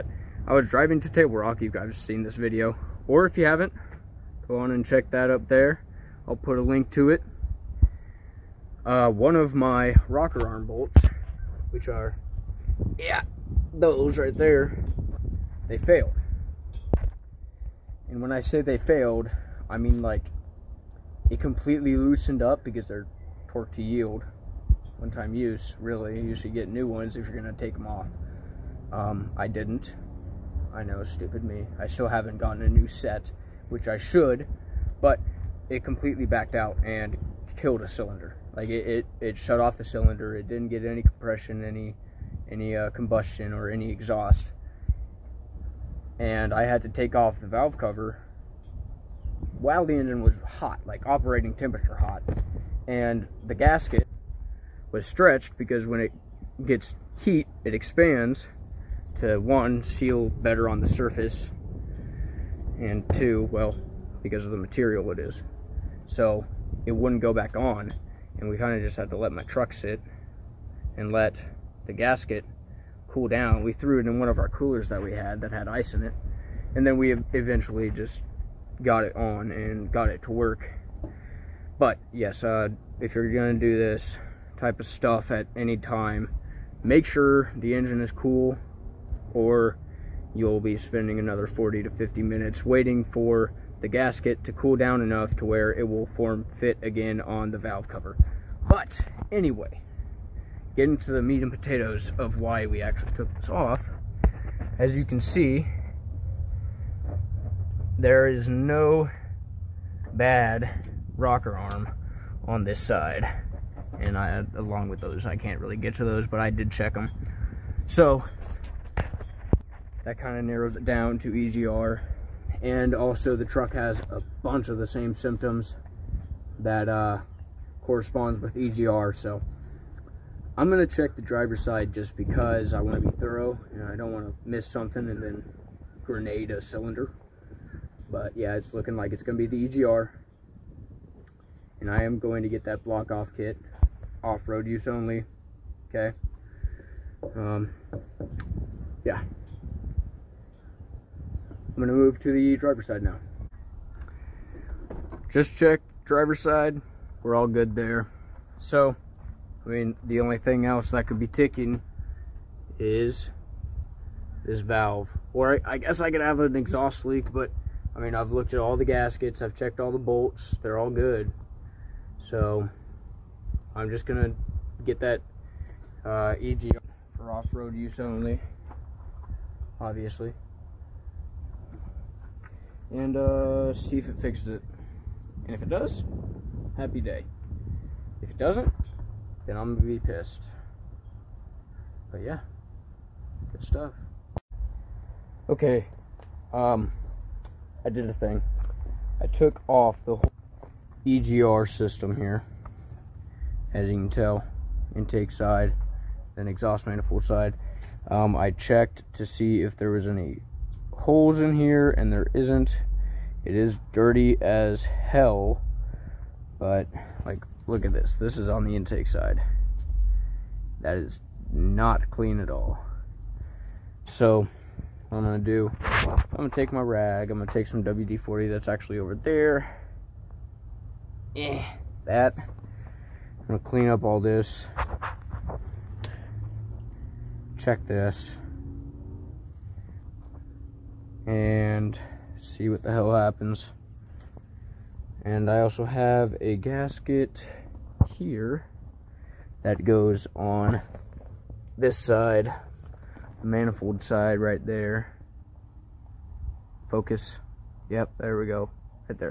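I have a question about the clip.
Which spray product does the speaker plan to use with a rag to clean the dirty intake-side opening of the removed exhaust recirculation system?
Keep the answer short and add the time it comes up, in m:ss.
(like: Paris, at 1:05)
WD-40, at 3:47.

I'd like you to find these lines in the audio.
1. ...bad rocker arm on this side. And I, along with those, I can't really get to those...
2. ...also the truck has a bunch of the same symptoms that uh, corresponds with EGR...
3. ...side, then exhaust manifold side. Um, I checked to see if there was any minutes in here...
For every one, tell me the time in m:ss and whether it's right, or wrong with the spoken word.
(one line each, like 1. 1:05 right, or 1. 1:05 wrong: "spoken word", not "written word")
1. 1:50 right
2. 2:02 right
3. 3:25 wrong: "holes", not "minutes".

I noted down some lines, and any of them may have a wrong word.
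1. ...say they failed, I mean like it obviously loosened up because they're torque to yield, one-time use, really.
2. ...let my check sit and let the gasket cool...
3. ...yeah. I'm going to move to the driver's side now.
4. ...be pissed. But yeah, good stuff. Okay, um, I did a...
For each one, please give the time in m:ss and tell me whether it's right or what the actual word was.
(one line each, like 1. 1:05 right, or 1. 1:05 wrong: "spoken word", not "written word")
1. 0:18 wrong: "completely", not "obviously"
2. 1:09 wrong: "truck", not "check"
3. 2:29 right
4. 3:09 right.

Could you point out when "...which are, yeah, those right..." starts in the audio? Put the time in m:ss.
0:11.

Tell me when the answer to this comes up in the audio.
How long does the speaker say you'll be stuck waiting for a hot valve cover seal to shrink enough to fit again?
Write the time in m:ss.
1:31.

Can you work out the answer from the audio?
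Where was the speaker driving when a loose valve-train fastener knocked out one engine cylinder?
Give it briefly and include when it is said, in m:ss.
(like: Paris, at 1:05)
Table Rock, at 0:01.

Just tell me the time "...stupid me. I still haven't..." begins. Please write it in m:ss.
0:31.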